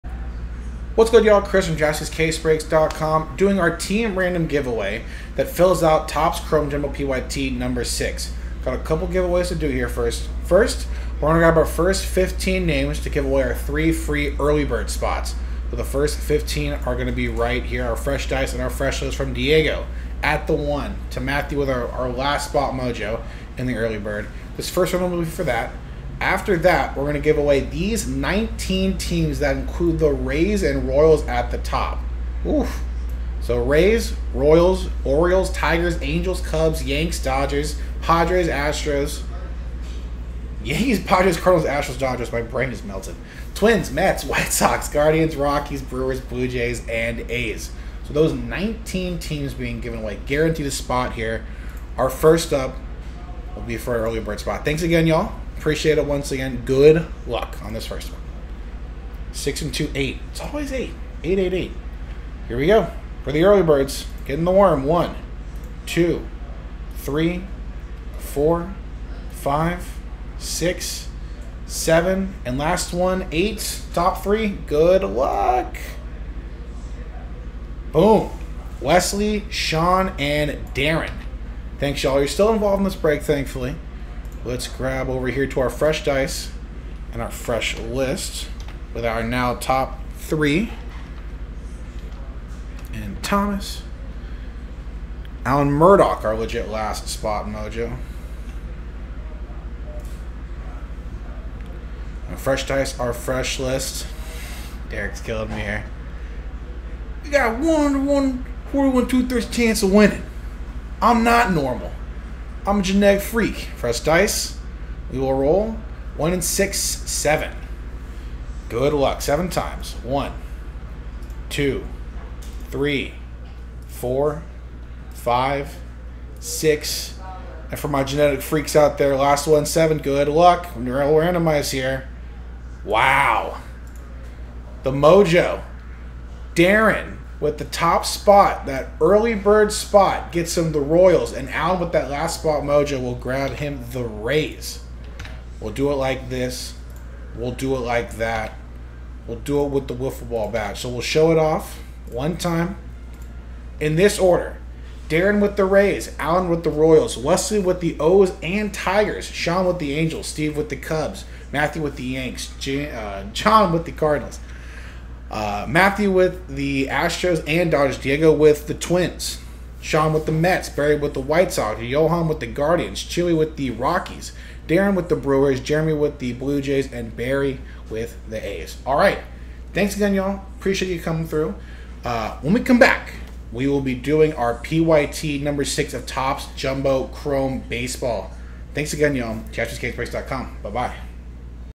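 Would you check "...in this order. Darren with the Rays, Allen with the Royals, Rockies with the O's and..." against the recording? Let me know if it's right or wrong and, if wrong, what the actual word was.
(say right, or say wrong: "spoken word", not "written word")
wrong: "Wesley", not "Rockies".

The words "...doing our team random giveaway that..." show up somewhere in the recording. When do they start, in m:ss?
0:03.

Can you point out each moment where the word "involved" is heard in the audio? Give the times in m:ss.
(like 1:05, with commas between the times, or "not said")
1:22.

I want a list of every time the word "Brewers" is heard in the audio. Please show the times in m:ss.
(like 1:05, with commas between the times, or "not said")
0:45, 2:55.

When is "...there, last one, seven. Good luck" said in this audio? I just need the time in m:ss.
2:08.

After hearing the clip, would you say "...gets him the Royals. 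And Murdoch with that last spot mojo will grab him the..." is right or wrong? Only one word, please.
wrong.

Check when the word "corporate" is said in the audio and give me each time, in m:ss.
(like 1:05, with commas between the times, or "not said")
not said.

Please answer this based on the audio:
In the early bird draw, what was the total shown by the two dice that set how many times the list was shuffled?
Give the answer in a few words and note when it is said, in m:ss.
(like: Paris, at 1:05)
8, at 0:59.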